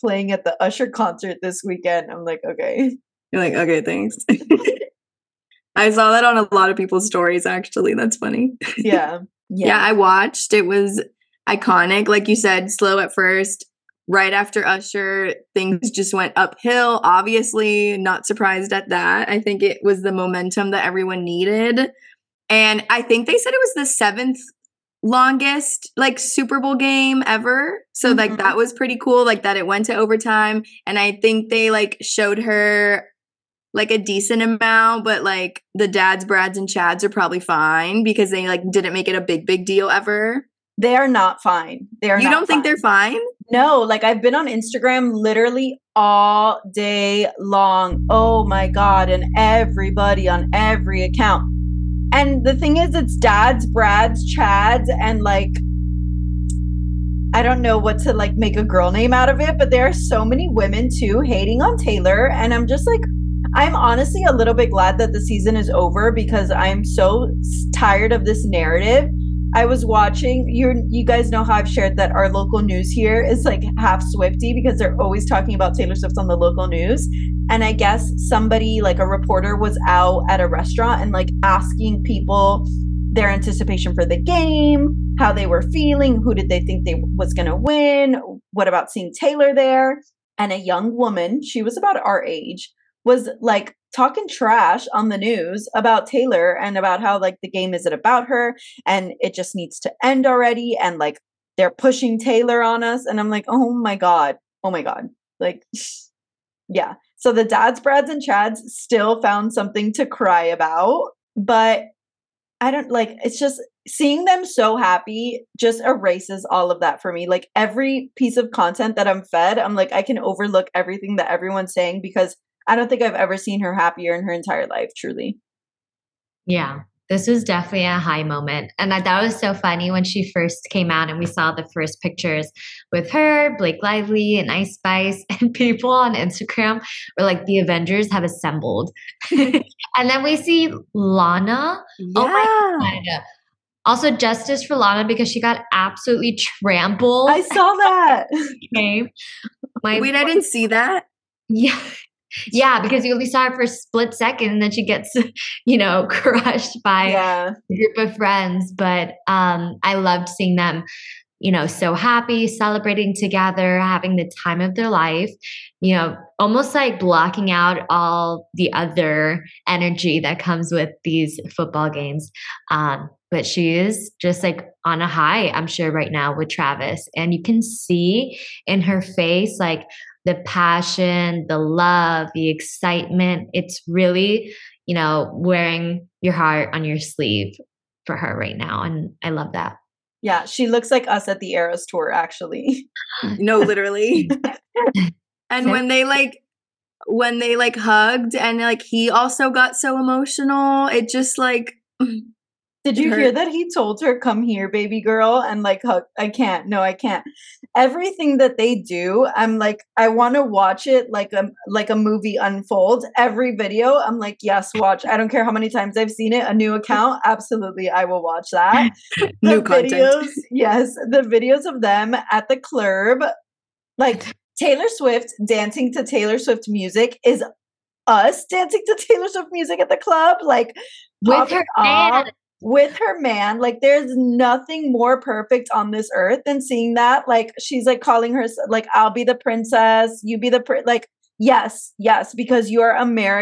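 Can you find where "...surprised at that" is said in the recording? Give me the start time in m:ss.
0:18.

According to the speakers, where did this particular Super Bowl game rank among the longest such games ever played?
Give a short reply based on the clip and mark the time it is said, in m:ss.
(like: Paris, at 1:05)
7th longest, at 0:23.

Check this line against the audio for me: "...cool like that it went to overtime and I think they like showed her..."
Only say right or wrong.
right.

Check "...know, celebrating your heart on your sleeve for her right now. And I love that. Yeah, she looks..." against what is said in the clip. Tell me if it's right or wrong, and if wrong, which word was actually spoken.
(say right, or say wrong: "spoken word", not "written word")
wrong: "wearing", not "celebrating".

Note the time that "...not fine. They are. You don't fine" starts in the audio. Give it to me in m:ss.
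0:41.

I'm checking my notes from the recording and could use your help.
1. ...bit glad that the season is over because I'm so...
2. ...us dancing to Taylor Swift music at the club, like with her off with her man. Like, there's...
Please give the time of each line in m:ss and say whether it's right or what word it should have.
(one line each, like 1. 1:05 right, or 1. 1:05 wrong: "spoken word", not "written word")
1. 1:04 right
2. 3:48 right.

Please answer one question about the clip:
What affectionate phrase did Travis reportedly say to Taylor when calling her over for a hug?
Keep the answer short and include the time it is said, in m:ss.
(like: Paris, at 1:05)
baby girl, at 3:24.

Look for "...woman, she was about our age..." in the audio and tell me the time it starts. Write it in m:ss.
1:30.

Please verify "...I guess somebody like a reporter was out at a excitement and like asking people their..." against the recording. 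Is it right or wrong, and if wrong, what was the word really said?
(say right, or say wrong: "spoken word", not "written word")
wrong: "restaurant", not "excitement".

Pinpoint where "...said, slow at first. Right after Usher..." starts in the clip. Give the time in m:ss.
0:12.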